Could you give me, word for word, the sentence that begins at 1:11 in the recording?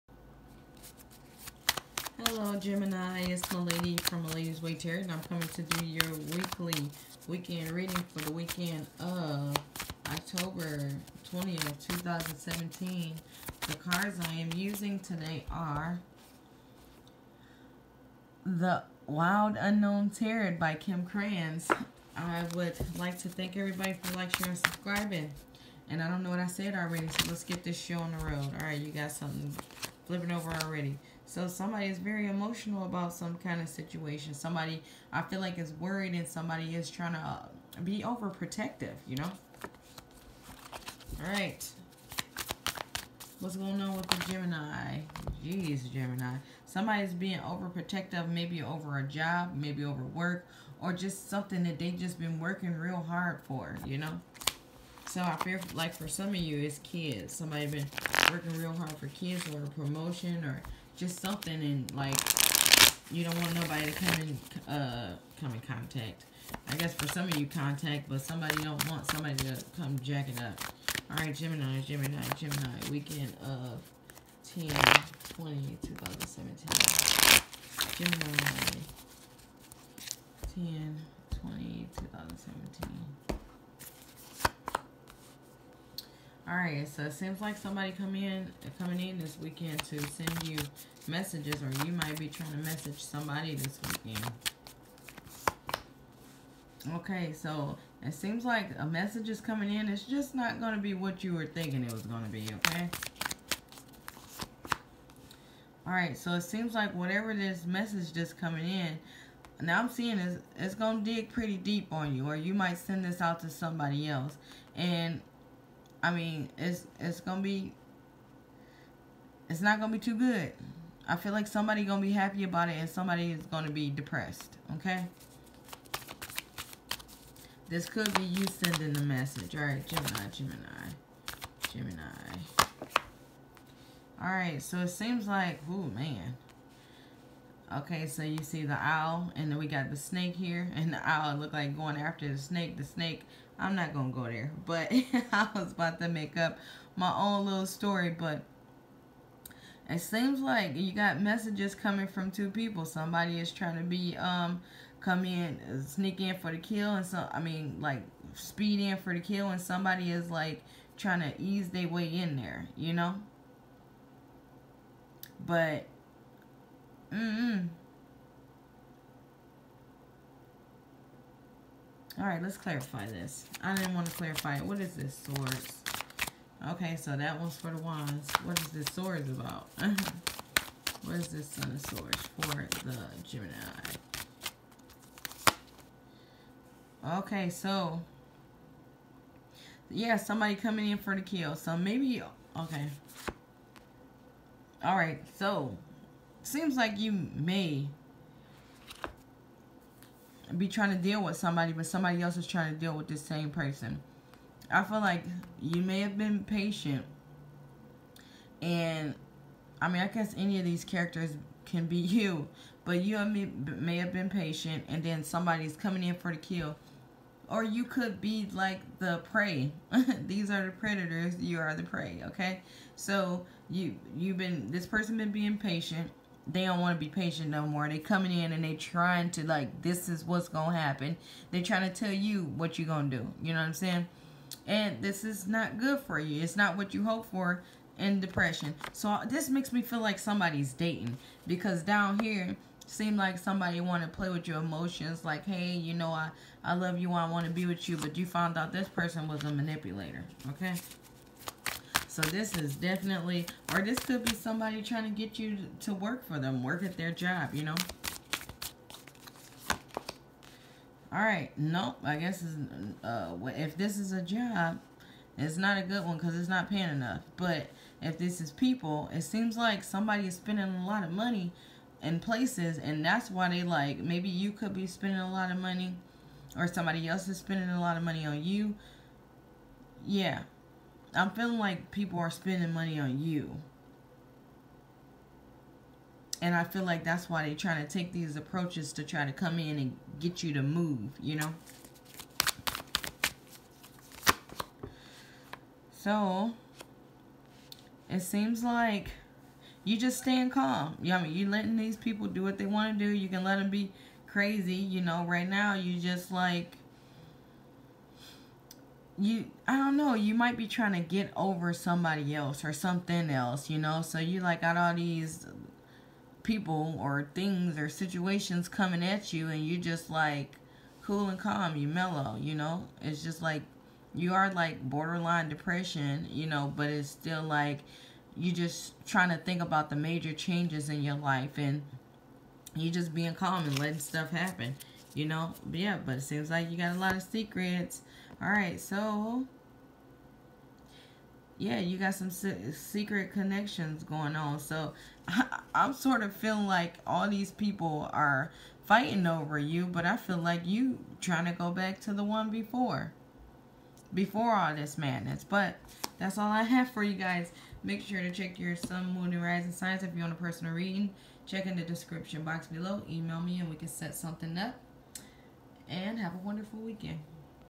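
Alright, Gemini, Gemini, Gemini, weekend of 10, 20, 2017.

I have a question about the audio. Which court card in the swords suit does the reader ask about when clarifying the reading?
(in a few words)
Son of Swords.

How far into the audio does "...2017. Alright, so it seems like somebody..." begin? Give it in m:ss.
1:21.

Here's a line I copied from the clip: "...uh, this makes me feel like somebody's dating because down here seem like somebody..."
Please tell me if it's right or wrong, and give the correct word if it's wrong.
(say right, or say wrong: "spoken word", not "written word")
right.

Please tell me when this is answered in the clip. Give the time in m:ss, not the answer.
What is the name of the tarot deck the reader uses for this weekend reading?
0:18.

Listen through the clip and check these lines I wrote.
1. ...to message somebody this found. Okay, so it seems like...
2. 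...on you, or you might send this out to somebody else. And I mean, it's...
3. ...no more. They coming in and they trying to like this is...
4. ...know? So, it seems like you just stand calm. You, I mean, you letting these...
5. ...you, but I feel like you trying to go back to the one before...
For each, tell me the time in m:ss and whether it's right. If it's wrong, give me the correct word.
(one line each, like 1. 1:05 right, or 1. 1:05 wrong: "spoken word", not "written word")
1. 1:32 wrong: "weekend", not "found"
2. 1:51 right
3. 3:47 right
4. 4:51 right
5. 5:49 right.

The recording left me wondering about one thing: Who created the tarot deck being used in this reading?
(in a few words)
Kim Krans.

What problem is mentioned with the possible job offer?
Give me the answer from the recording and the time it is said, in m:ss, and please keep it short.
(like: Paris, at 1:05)
not paying enough, at 4:26.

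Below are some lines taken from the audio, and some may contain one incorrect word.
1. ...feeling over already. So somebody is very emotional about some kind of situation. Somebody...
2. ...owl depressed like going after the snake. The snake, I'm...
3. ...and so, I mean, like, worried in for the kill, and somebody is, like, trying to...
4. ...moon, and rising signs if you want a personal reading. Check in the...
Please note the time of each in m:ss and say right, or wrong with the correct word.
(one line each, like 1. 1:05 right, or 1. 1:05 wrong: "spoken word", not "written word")
1. 0:30 wrong: "flipping", not "feeling"
2. 2:21 wrong: "looked", not "depressed"
3. 2:36 wrong: "speed", not "worried"
4. 5:59 right.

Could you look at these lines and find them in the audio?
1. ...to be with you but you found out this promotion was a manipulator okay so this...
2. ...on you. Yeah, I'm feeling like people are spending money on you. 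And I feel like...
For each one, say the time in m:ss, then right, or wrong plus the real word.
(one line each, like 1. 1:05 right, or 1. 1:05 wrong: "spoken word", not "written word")
1. 4:07 wrong: "person", not "promotion"
2. 4:38 right.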